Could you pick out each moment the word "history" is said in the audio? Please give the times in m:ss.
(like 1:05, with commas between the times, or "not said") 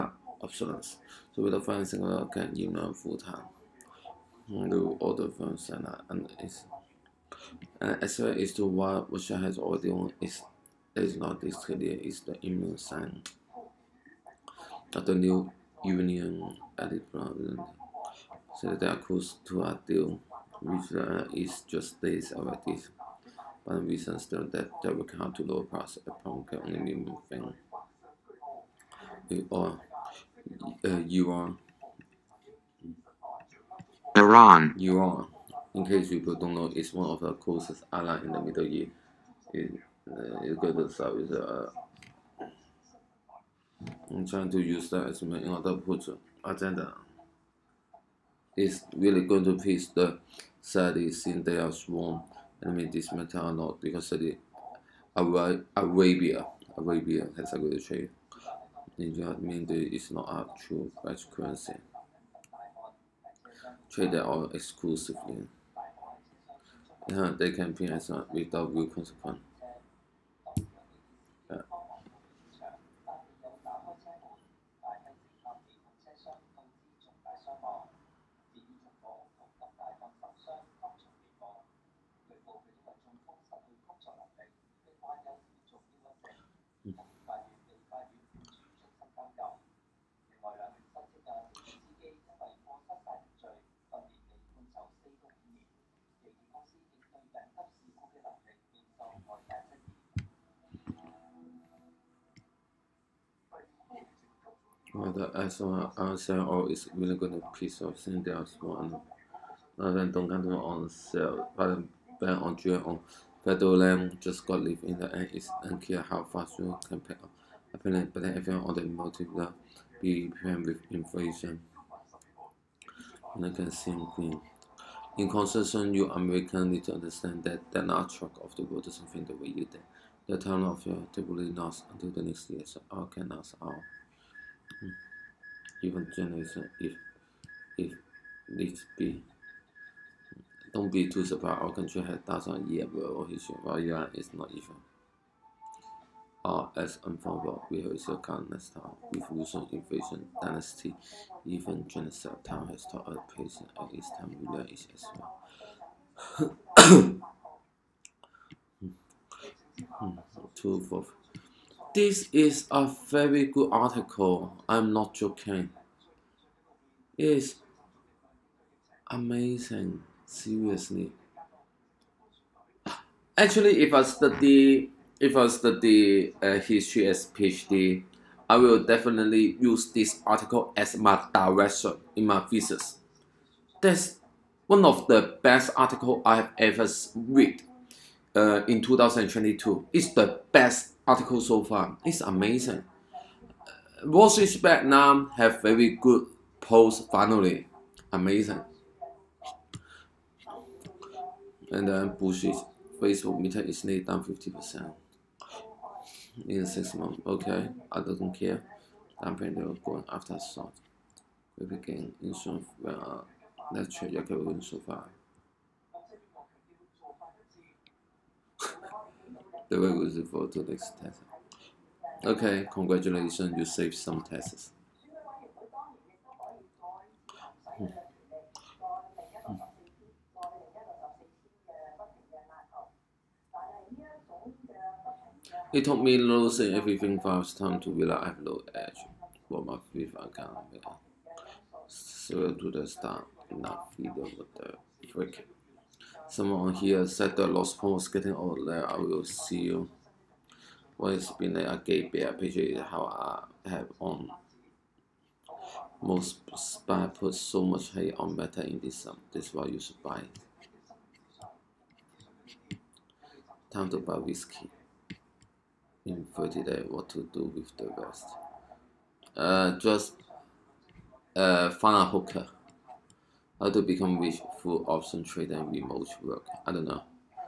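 2:23, 2:56.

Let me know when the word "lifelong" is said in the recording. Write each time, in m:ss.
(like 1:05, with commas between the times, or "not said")
not said.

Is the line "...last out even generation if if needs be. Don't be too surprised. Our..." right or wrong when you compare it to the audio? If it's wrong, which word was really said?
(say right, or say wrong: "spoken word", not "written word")
right.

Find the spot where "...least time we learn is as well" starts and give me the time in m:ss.
2:33.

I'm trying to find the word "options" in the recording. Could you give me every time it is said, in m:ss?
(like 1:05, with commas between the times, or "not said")
0:00, 4:34.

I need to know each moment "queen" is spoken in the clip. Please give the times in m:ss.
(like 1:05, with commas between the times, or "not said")
2:04.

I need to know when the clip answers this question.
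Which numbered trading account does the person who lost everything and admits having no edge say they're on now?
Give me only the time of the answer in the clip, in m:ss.
3:59.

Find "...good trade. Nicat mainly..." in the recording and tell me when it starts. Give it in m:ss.
0:57.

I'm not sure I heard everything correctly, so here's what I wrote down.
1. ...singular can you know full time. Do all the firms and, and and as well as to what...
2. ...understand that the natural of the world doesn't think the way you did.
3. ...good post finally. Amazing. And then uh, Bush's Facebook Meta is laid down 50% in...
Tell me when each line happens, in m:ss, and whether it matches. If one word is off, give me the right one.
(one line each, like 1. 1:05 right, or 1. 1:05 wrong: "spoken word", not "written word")
1. 0:01 right
2. 2:06 right
3. 3:15 right.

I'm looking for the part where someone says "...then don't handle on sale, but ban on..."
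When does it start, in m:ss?
1:49.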